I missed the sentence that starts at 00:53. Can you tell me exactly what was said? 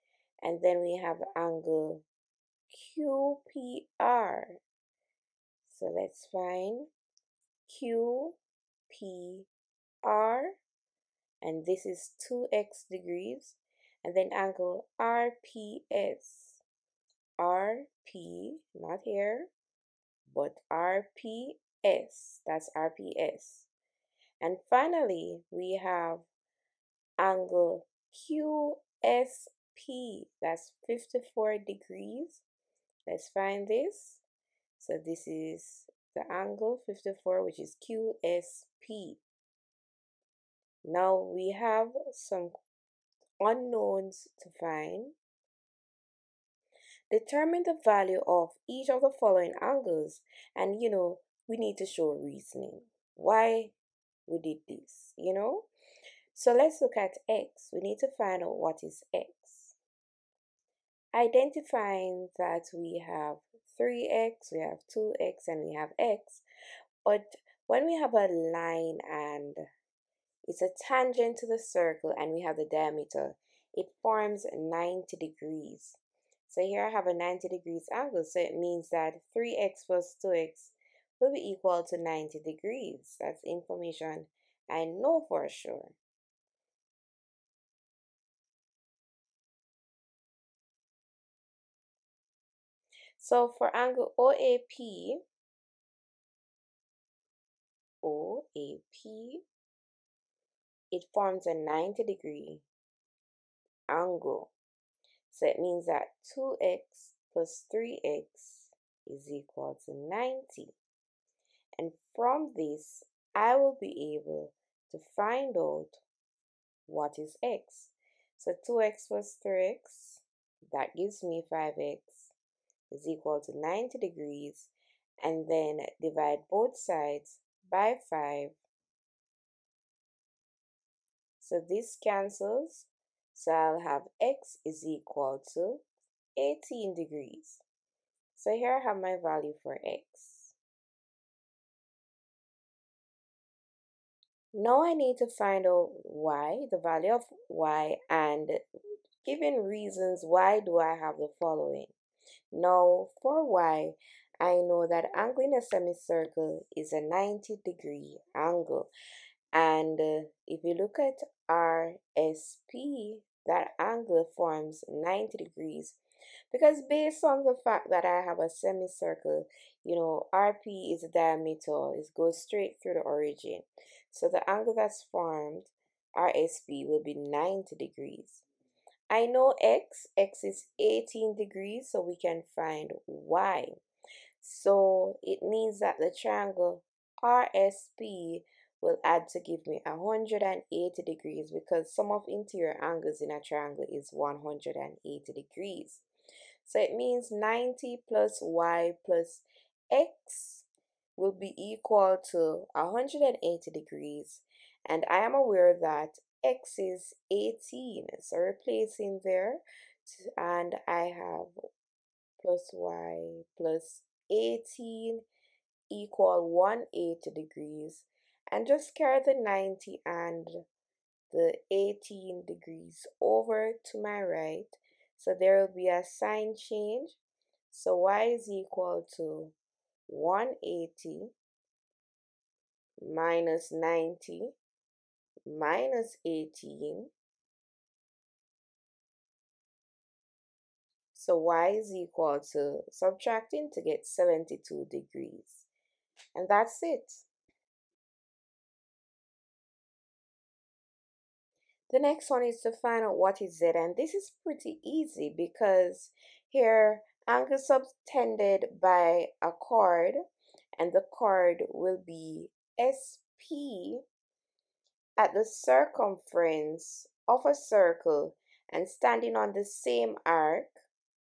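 Why we did this, you know?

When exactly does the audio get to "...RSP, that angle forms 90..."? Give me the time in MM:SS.
02:41.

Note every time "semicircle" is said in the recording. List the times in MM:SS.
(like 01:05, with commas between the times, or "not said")
02:35, 02:48.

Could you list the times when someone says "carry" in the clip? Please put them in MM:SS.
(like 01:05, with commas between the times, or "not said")
03:38.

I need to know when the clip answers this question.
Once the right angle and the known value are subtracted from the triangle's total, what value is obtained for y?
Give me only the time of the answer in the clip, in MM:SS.
04:04.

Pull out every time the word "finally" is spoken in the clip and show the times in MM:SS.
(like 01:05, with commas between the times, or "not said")
00:24.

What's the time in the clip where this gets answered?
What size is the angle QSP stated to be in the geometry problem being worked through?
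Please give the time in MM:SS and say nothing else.
00:30.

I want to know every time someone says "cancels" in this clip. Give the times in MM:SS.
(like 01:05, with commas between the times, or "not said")
02:12.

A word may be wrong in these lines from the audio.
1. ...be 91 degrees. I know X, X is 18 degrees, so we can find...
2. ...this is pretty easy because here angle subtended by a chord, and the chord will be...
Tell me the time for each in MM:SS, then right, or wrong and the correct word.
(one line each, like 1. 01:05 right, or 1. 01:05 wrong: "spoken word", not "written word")
1. 02:57 wrong: "90", not "91"
2. 04:13 right.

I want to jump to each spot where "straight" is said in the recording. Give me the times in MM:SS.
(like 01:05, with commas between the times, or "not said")
02:52.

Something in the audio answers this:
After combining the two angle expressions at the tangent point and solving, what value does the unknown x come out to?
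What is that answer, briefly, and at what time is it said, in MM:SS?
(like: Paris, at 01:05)
18 degrees, at 02:14.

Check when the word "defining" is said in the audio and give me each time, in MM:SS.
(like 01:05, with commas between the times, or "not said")
not said.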